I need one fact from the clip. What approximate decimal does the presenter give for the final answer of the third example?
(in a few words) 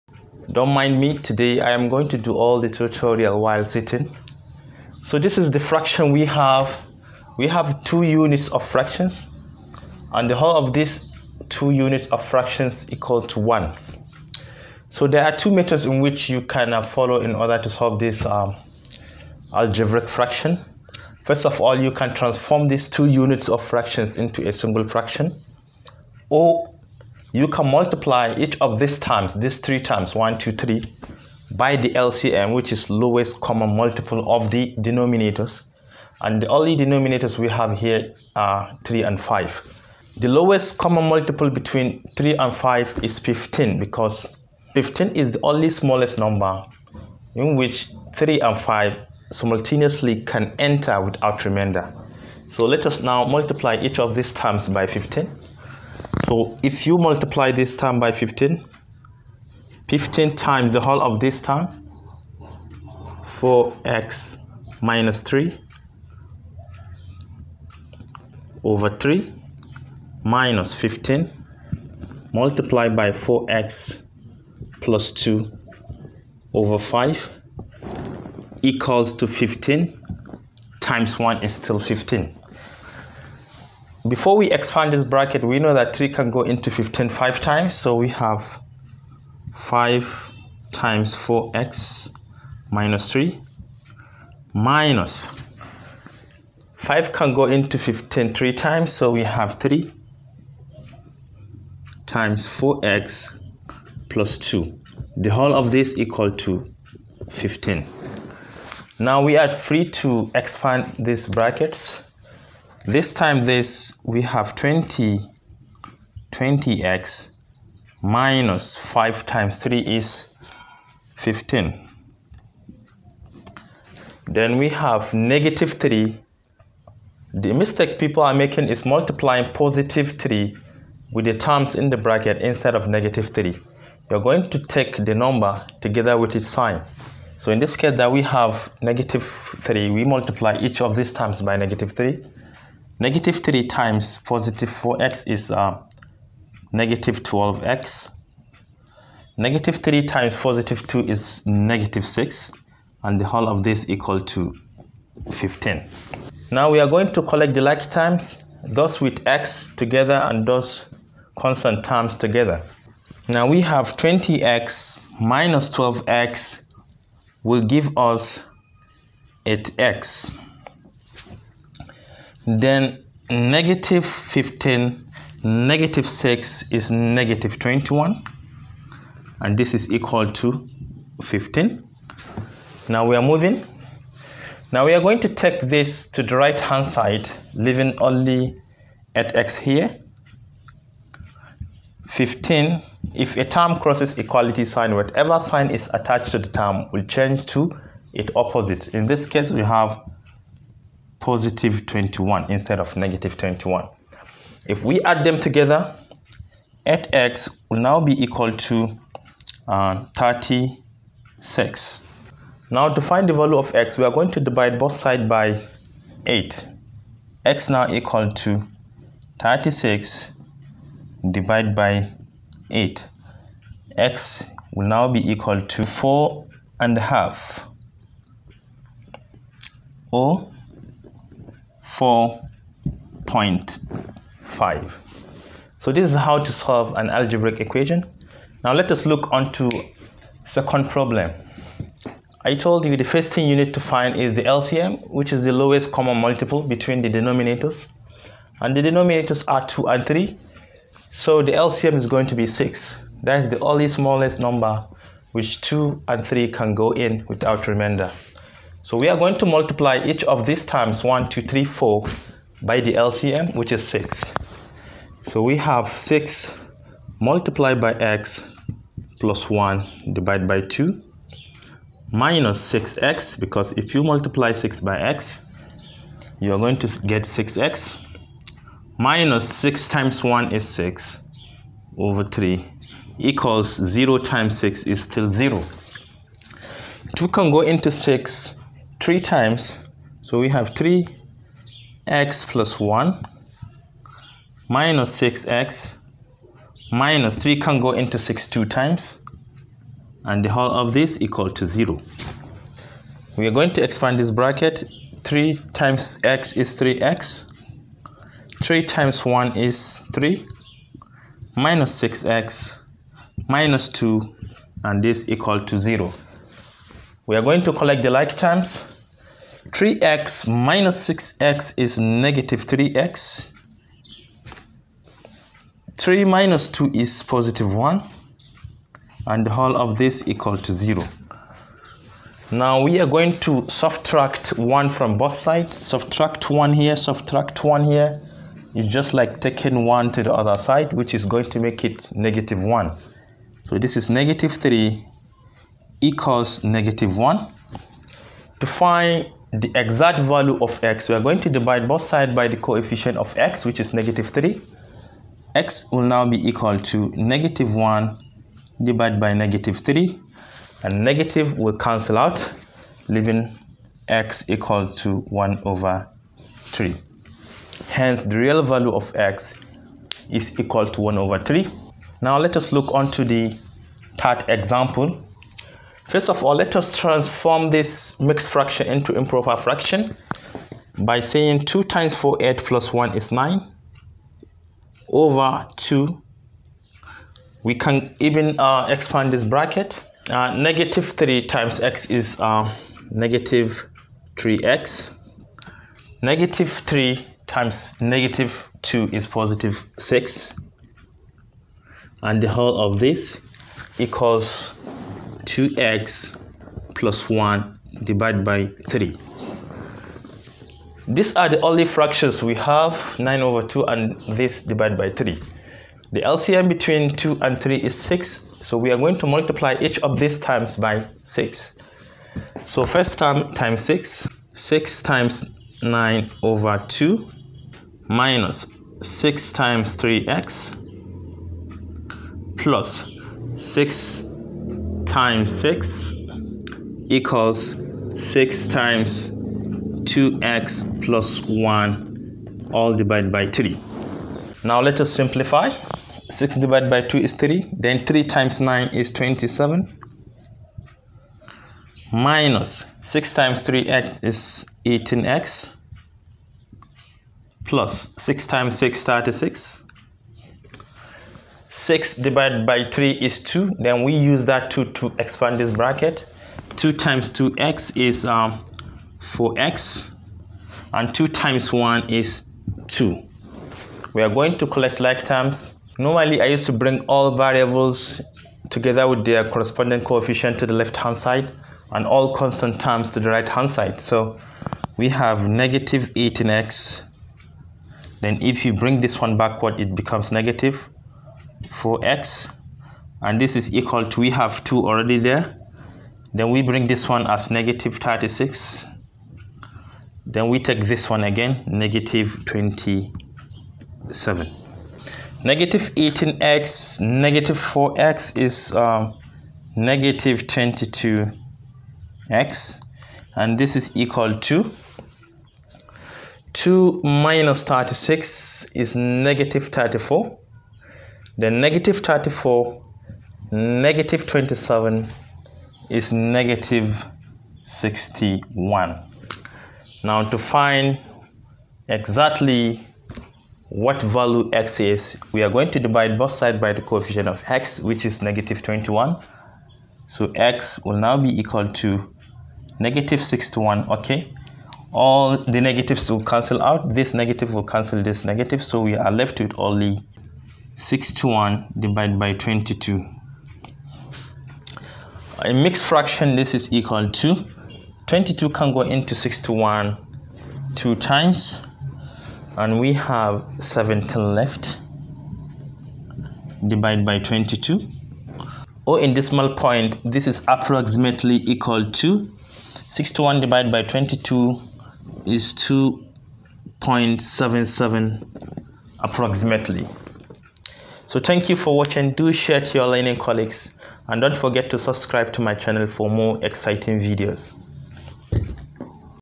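2.77.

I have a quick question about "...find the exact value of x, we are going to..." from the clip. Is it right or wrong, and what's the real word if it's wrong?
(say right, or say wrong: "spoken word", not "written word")
right.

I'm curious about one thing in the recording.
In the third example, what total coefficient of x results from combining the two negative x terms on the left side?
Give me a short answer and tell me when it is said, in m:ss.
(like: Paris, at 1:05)
-22, at 8:29.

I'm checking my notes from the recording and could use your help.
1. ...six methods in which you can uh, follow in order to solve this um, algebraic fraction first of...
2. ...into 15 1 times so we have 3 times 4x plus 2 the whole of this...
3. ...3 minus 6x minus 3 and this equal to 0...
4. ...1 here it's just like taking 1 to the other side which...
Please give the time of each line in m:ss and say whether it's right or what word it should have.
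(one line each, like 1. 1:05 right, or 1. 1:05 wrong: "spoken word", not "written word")
1. 0:15 wrong: "two", not "six"
2. 1:37 wrong: "3", not "1"
3. 5:10 wrong: "2", not "3"
4. 5:37 right.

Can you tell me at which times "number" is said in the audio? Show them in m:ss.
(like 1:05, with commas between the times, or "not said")
0:46, 2:15, 4:14.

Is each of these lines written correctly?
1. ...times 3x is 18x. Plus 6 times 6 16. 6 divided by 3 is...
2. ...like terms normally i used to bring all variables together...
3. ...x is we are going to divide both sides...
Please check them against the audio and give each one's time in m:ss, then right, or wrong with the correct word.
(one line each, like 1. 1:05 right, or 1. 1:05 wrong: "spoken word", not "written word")
1. 7:33 wrong: "36", not "16"
2. 7:54 right
3. 8:54 right.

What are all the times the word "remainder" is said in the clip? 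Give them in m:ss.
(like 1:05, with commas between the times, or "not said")
0:51, 4:17.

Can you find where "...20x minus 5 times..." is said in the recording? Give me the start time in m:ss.
1:56.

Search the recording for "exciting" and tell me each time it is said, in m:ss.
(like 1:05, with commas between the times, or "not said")
9:46.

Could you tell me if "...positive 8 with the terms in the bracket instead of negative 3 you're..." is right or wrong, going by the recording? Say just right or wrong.
wrong.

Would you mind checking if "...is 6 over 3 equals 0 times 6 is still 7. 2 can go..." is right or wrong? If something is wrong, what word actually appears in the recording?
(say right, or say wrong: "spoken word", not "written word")
wrong: "0", not "7".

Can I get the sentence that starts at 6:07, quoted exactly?
Hence, the real value of x is equal to 1 over 3.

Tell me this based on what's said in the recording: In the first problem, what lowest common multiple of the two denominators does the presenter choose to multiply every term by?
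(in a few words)
15.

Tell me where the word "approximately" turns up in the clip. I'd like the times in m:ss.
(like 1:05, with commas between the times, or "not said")
9:30, 9:38.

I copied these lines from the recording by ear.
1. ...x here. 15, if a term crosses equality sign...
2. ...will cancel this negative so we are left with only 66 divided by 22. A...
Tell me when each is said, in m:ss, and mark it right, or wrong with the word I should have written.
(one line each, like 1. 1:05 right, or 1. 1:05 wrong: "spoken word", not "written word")
1. 3:09 right
2. 9:07 wrong: "61", not "66".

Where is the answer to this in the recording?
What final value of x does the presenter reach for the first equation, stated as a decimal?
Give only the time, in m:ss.
3:52.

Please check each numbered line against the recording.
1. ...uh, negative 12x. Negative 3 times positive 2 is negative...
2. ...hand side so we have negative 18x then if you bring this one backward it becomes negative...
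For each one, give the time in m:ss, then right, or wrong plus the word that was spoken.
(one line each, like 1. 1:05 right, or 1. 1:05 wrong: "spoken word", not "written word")
1. 2:25 right
2. 8:03 right.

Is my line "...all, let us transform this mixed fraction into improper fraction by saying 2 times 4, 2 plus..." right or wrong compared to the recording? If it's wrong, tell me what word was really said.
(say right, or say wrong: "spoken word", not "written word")
wrong: "8", not "2".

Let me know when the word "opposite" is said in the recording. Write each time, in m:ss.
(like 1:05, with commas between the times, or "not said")
3:18.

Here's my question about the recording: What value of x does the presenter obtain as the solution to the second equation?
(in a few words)
1/3.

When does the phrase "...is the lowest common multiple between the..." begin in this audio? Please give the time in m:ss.
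4:05.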